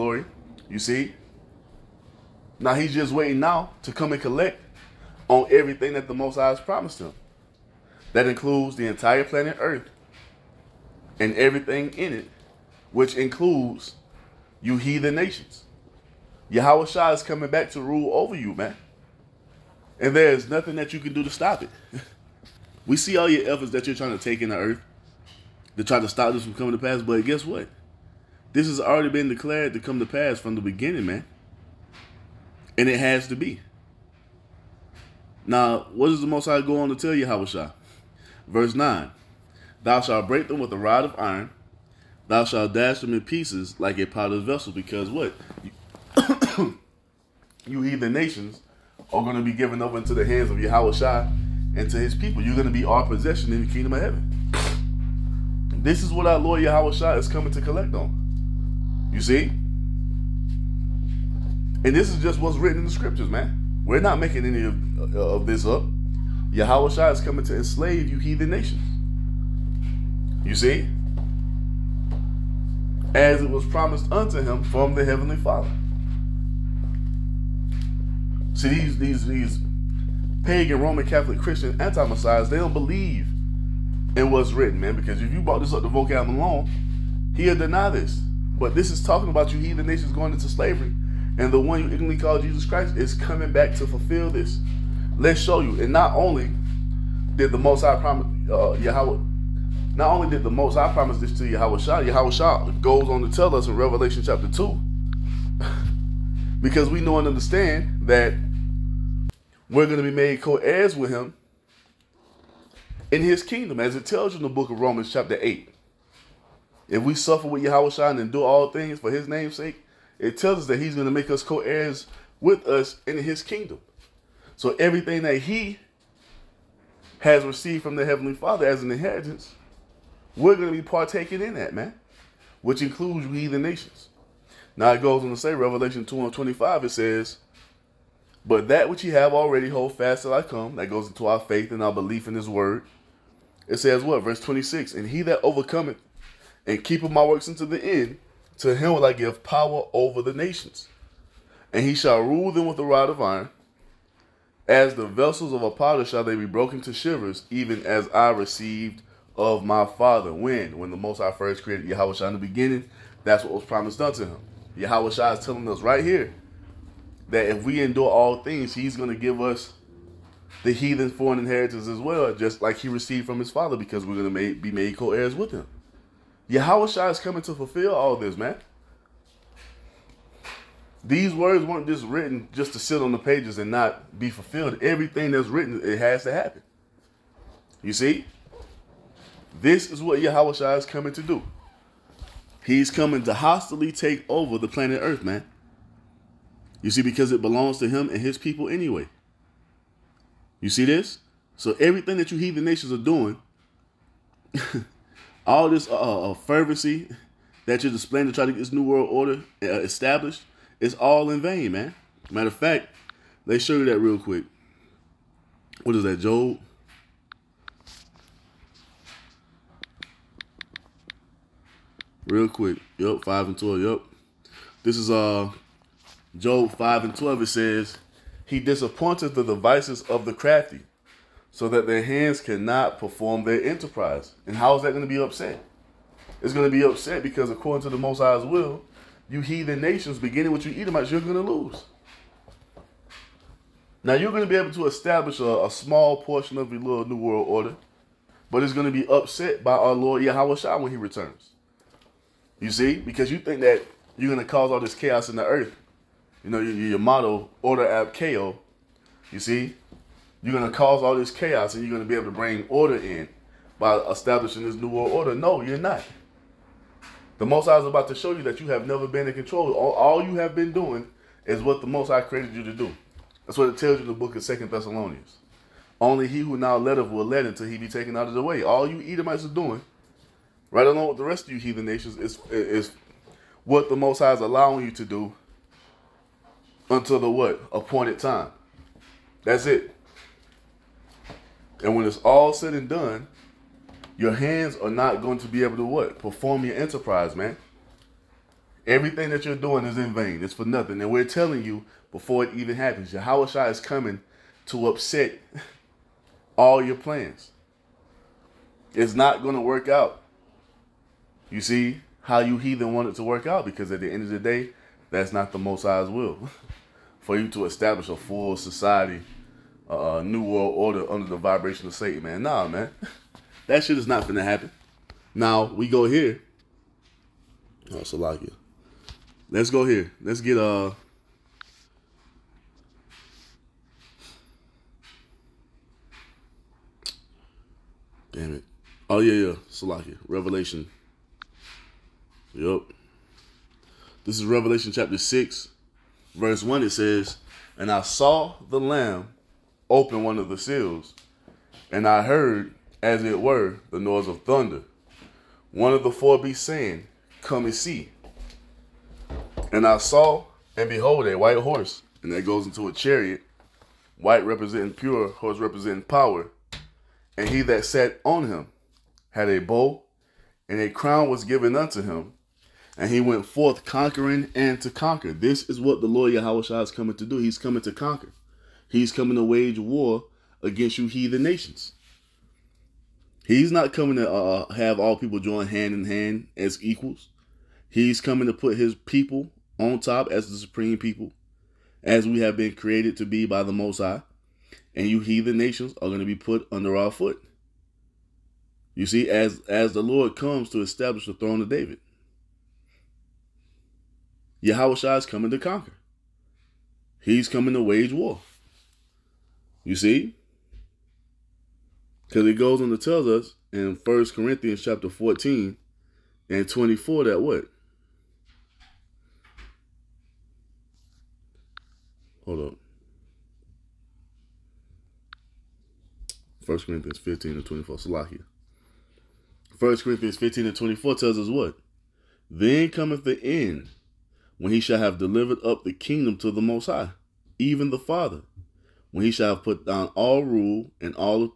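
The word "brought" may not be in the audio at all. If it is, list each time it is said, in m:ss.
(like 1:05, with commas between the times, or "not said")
1:25.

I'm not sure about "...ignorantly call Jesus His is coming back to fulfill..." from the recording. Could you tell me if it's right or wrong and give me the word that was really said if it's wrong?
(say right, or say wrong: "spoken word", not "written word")
wrong: "Christ", not "His".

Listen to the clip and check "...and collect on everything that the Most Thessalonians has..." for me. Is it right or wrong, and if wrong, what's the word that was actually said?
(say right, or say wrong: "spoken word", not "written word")
wrong: "High", not "Thessalonians".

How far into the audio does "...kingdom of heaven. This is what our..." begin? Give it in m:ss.
0:53.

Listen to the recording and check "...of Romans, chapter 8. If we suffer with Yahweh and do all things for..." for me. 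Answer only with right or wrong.
right.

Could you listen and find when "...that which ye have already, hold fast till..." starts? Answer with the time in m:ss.
2:18.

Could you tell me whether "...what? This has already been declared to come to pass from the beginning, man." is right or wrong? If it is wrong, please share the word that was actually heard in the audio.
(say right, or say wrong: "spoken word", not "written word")
right.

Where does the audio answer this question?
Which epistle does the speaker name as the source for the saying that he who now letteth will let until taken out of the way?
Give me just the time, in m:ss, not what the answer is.
4:34.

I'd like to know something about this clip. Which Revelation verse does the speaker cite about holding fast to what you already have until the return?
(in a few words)
Revelation 2:25.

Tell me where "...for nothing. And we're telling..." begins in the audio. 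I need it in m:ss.
5:00.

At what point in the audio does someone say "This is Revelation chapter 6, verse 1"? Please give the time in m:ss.
5:44.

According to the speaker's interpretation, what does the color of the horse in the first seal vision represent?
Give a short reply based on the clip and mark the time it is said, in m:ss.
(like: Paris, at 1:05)
pure, at 6:04.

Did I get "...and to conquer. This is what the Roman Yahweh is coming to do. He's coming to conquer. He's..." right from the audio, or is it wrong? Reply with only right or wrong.
wrong.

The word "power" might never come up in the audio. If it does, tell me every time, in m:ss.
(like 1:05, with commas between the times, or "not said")
2:29, 6:06.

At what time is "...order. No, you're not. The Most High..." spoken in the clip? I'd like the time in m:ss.
4:25.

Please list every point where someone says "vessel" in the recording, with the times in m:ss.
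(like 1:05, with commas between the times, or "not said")
0:44, 2:35.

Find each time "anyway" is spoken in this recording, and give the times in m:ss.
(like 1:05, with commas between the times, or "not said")
3:18.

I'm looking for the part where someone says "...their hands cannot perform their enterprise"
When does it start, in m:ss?
3:51.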